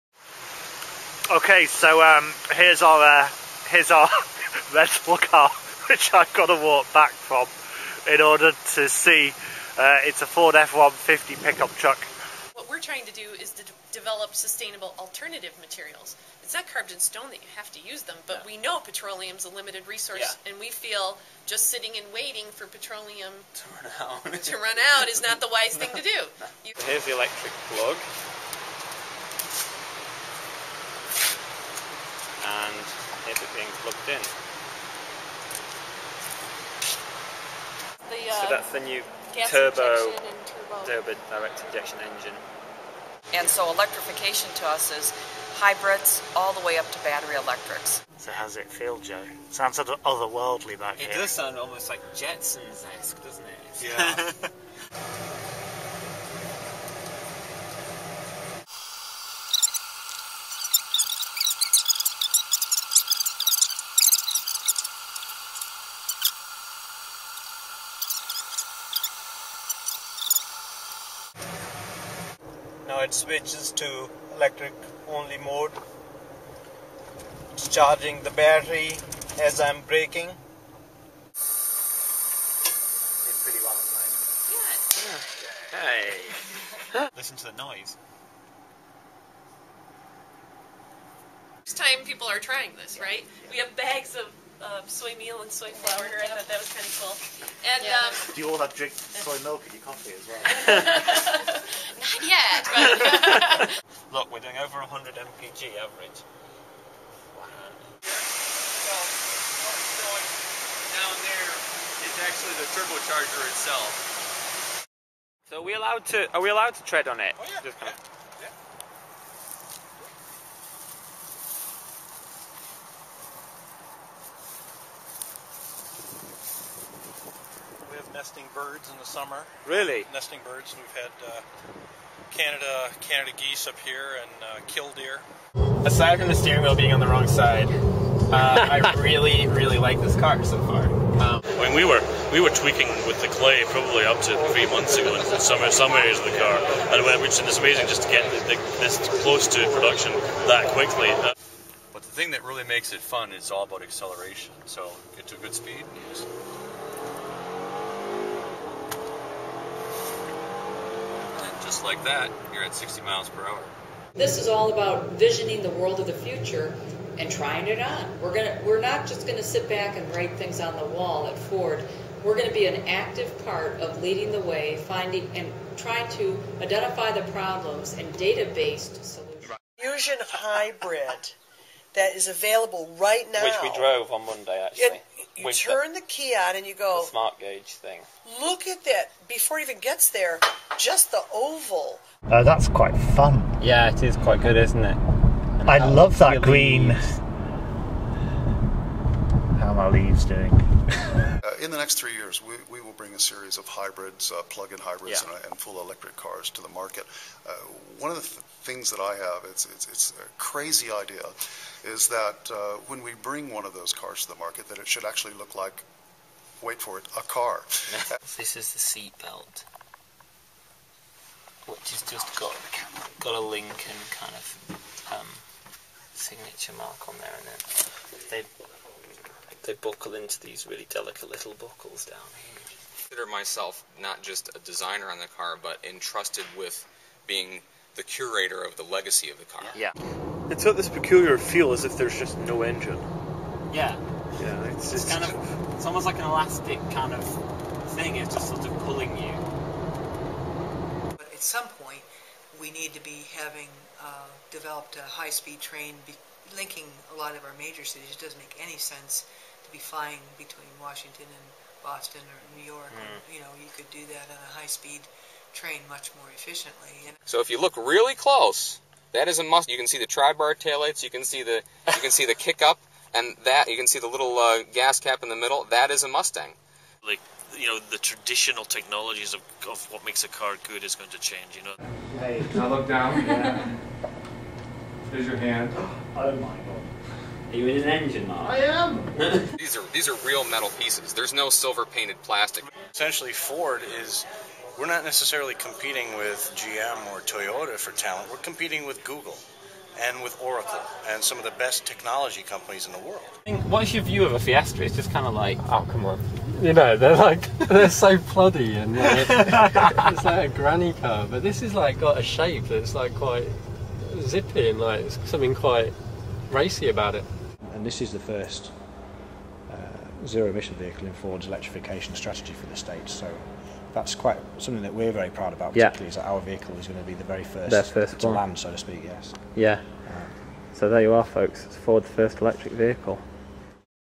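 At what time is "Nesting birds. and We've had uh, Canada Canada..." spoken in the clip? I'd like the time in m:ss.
2:10.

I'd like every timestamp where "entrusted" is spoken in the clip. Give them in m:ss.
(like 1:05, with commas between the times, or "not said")
3:55.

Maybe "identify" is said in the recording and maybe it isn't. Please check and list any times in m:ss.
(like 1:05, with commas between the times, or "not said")
2:56.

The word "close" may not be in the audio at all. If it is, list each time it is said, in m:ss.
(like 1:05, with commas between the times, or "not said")
2:29, 4:28.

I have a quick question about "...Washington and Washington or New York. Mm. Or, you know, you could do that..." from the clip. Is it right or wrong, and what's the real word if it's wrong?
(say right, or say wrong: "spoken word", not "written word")
wrong: "Boston", not "Washington".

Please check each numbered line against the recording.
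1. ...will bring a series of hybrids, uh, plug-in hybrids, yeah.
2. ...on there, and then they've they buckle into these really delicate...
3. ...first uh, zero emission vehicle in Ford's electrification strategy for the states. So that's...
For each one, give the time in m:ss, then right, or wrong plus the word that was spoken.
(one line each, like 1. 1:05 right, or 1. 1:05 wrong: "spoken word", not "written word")
1. 3:22 right
2. 3:47 right
3. 5:18 right.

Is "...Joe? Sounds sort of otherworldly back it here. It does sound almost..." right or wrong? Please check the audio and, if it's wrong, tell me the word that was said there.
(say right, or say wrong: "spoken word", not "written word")
right.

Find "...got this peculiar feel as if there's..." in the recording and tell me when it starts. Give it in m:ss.
4:00.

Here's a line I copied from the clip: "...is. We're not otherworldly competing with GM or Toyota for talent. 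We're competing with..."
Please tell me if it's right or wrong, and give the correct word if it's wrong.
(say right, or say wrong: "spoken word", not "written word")
wrong: "necessarily", not "otherworldly".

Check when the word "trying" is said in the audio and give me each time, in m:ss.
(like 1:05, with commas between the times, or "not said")
0:12, 1:32, 2:47, 2:55.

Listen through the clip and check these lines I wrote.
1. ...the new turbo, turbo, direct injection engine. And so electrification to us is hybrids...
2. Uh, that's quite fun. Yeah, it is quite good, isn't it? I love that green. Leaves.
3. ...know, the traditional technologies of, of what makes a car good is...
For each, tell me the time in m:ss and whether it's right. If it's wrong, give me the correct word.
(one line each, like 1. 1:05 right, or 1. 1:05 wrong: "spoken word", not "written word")
1. 0:38 right
2. 3:12 right
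3. 4:37 right.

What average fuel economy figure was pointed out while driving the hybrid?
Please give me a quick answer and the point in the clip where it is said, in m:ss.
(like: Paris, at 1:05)
over 100 mpg, at 1:44.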